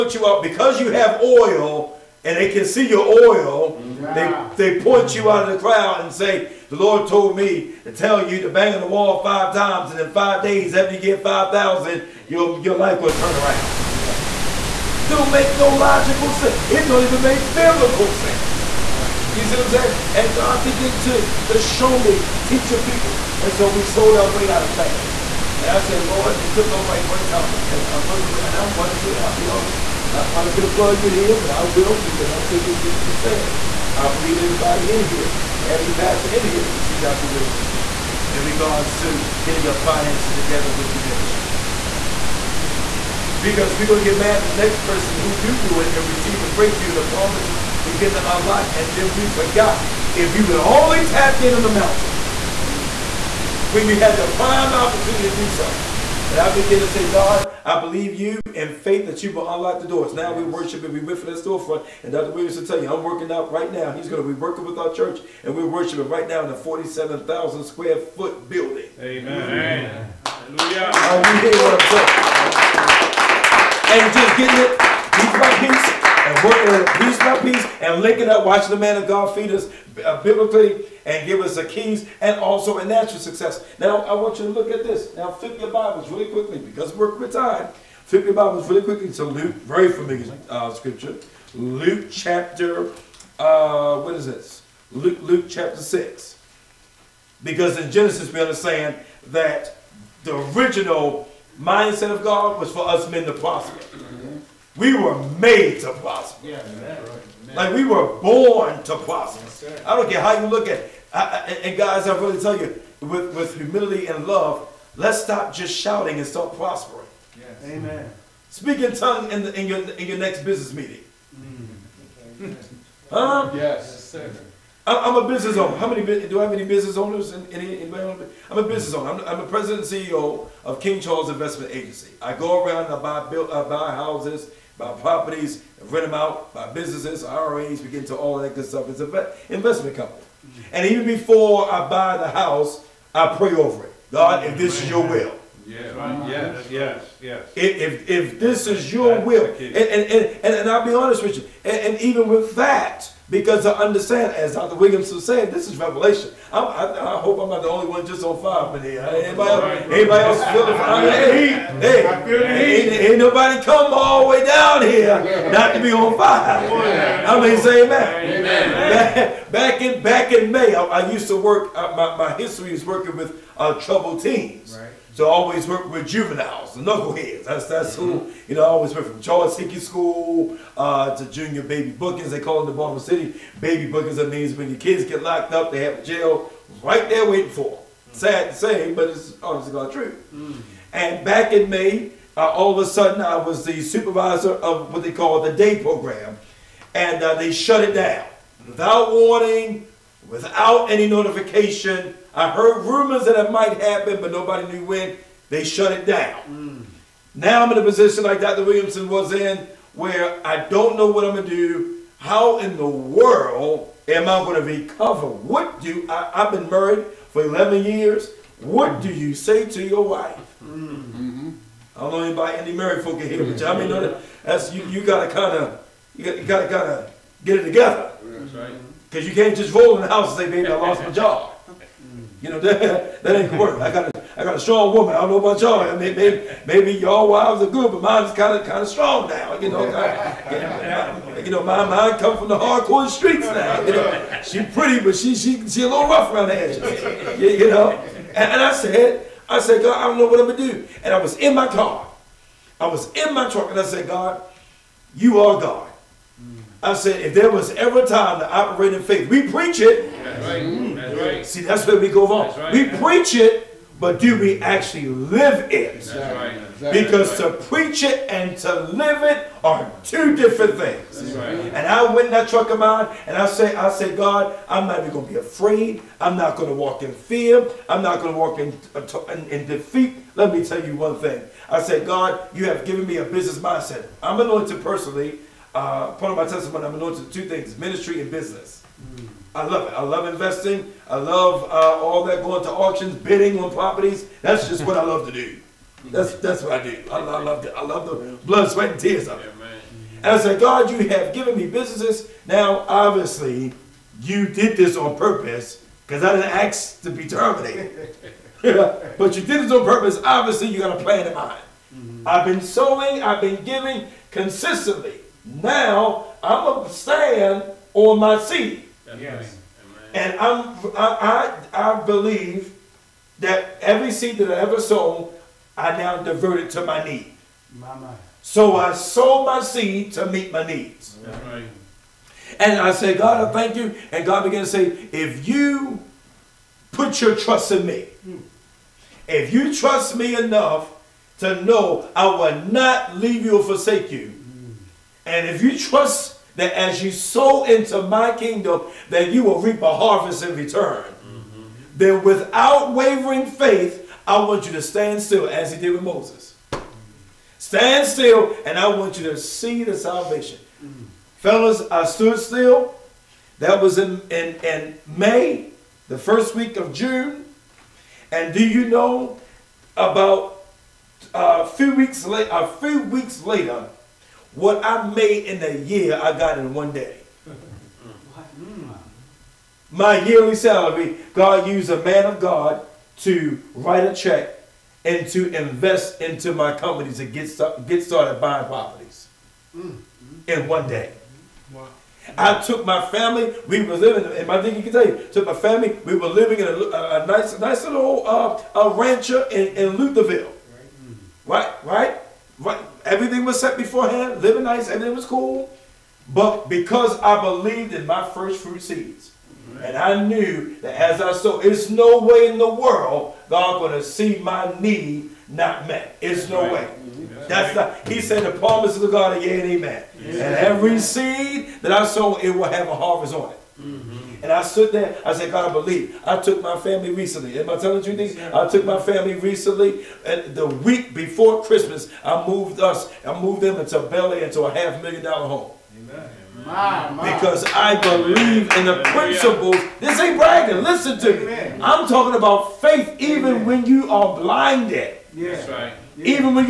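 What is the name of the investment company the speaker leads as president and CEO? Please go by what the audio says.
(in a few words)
King Charles Investment Agency.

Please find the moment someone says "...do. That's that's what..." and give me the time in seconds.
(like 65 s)
295 s.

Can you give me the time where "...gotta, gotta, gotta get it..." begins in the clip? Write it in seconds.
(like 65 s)
226 s.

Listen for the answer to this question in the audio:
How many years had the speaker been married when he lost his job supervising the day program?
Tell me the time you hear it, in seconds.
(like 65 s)
217 s.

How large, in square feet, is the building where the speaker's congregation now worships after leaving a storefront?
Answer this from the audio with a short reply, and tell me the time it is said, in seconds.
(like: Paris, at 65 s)
47,000, at 66 s.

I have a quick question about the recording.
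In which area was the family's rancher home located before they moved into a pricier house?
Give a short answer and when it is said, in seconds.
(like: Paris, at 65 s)
Lutherville, at 399 s.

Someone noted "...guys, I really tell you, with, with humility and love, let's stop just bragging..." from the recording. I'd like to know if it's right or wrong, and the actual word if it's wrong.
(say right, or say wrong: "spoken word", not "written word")
wrong: "shouting", not "bragging".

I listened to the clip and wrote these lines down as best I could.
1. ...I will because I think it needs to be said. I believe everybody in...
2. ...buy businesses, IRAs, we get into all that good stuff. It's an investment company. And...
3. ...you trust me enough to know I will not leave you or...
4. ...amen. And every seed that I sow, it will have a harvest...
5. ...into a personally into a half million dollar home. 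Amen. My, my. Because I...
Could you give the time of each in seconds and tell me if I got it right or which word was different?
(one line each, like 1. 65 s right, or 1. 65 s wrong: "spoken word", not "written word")
1. 31 s right
2. 136 s right
3. 339 s right
4. 419 s right
5. 433 s wrong: "belly", not "personally".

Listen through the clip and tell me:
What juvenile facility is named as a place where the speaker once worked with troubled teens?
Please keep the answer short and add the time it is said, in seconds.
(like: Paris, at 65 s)
Charles Hickey School, at 179 s.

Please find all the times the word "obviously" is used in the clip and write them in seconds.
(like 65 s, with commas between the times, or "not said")
189 s, 302 s, 310 s.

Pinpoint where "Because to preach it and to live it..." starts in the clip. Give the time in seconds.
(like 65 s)
266 s.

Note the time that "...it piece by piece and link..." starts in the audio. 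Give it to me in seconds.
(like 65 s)
74 s.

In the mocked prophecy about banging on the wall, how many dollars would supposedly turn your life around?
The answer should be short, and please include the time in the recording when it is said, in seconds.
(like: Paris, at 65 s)
5,000, at 11 s.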